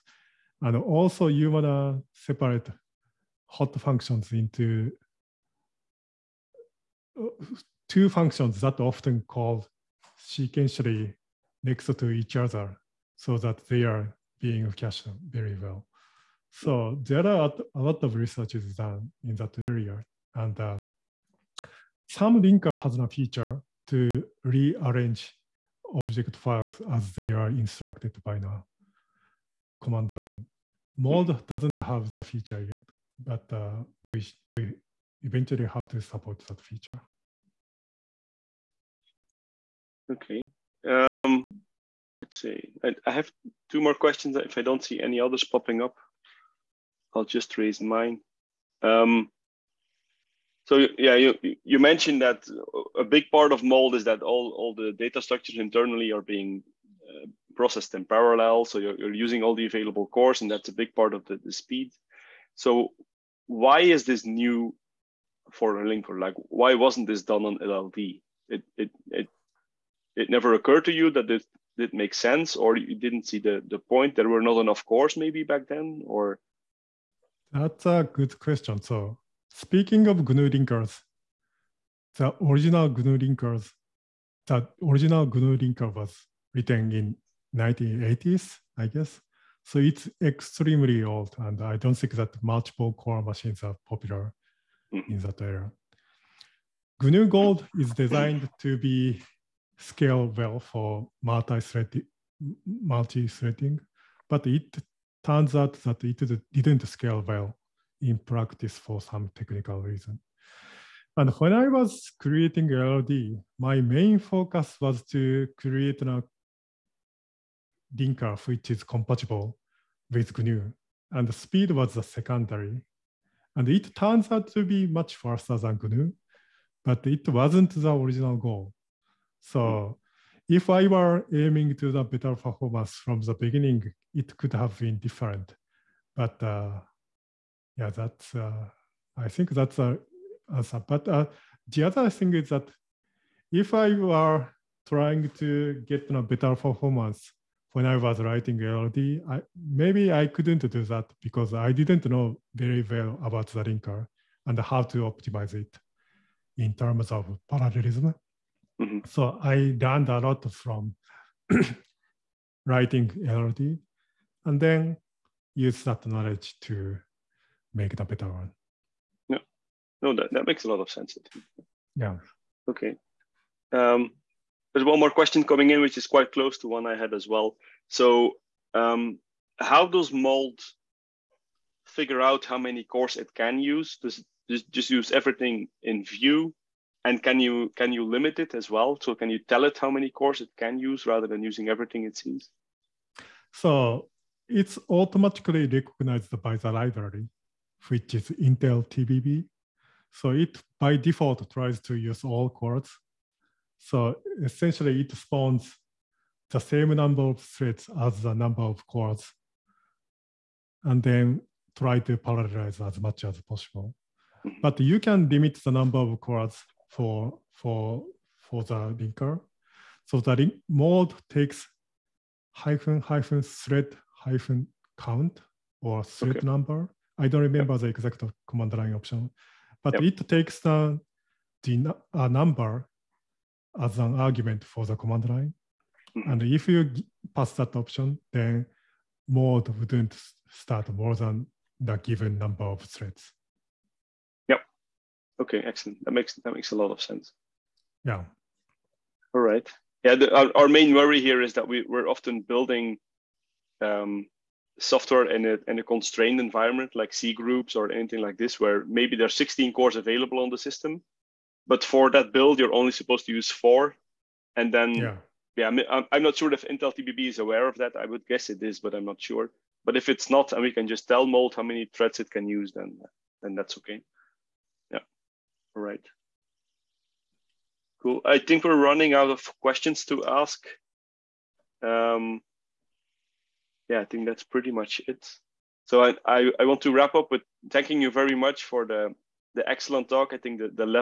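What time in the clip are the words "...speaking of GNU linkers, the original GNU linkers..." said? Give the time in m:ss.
1:19.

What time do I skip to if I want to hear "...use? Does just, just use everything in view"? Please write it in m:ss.
3:03.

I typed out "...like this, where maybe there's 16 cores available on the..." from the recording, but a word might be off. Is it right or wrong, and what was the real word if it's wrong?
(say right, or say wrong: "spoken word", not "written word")
right.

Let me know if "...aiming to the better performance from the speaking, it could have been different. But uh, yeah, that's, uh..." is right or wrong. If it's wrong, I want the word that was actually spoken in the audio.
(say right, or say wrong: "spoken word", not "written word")
wrong: "beginning", not "speaking".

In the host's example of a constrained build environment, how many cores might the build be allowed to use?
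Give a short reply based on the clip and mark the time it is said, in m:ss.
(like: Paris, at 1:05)
4, at 4:23.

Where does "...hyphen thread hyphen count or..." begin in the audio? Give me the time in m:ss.
3:43.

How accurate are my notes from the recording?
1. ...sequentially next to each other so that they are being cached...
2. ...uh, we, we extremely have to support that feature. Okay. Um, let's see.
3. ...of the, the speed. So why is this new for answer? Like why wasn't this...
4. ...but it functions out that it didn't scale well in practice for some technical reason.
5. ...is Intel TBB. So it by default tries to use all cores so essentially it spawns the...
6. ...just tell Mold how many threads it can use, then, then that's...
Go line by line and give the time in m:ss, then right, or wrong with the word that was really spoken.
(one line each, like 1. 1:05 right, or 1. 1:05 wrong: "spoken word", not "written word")
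1. 0:10 right
2. 0:33 wrong: "eventually", not "extremely"
3. 1:01 wrong: "linker", not "answer"
4. 1:44 wrong: "turns", not "functions"
5. 3:18 right
6. 4:30 right.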